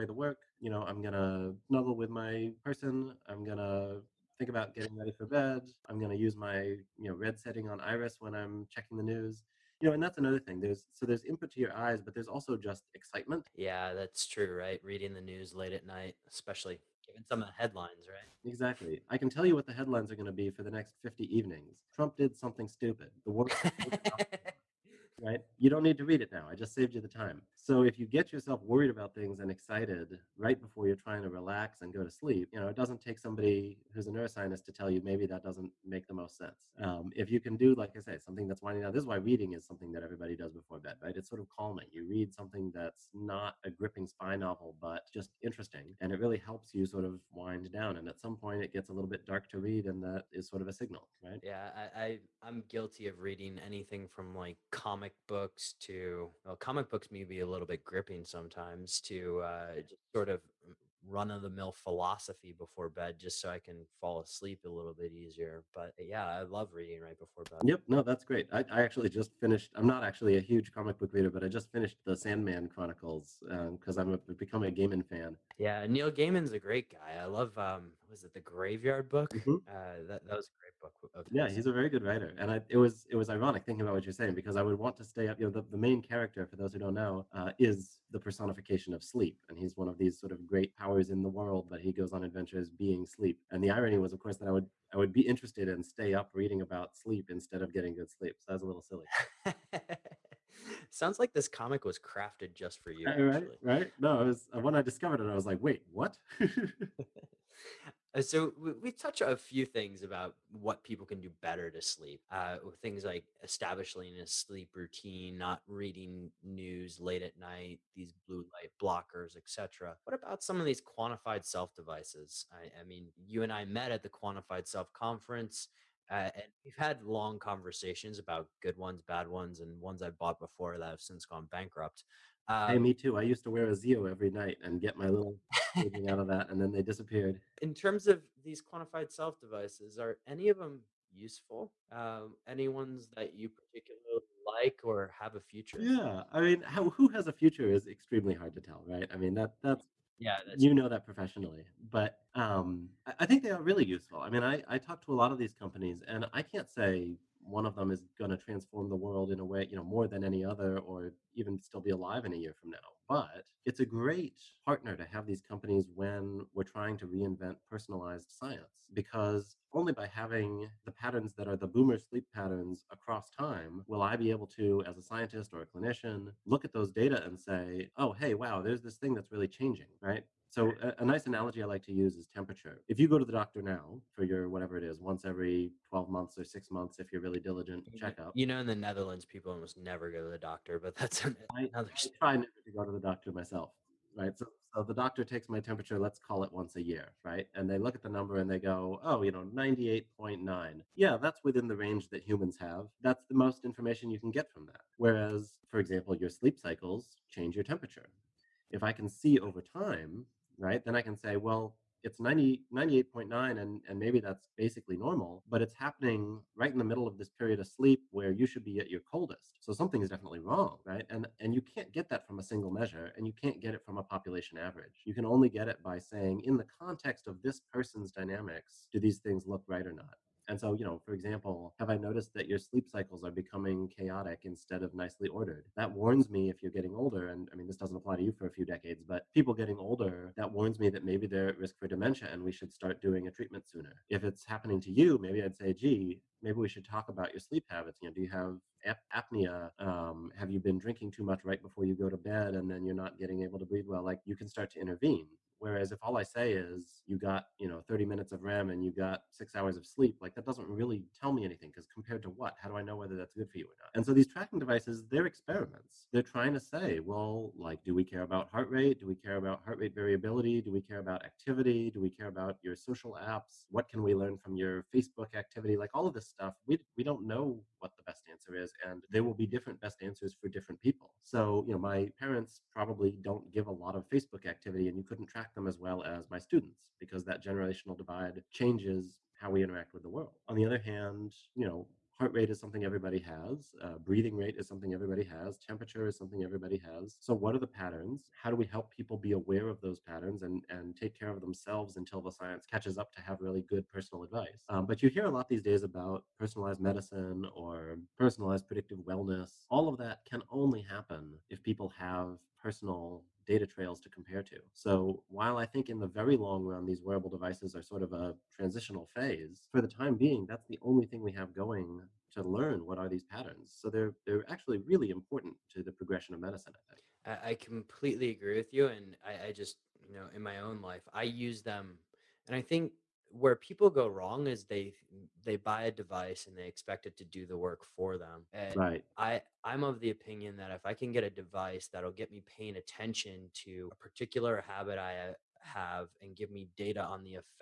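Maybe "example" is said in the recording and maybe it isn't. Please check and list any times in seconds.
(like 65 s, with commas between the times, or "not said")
205 s, 231 s.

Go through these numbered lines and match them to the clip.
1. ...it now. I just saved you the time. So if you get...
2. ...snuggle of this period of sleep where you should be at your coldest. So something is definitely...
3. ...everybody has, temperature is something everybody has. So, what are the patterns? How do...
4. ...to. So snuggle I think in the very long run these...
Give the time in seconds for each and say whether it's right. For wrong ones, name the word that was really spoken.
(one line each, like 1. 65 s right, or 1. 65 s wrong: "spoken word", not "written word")
1. 26 s right
2. 216 s wrong: "middle", not "snuggle"
3. 294 s right
4. 314 s wrong: "while", not "snuggle".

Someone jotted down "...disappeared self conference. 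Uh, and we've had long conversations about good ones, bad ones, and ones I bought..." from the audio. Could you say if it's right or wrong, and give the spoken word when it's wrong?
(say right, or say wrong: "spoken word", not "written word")
wrong: "quantified", not "disappeared".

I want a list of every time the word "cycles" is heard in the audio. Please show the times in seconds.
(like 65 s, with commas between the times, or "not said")
206 s, 232 s.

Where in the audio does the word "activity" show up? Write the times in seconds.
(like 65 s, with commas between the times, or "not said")
271 s, 275 s, 284 s.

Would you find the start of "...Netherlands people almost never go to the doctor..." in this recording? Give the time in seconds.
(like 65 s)
188 s.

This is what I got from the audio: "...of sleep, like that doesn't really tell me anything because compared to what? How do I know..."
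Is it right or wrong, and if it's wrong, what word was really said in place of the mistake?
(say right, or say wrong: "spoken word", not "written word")
right.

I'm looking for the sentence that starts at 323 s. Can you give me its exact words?
So they're they're actually really important to the progression of medicine, I think.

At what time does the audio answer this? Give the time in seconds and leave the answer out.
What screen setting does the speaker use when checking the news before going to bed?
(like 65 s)
7 s.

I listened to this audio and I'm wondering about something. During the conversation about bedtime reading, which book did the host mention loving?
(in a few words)
The Graveyard Book.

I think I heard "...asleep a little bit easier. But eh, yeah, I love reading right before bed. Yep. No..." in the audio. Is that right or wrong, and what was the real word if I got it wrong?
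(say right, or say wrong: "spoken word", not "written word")
right.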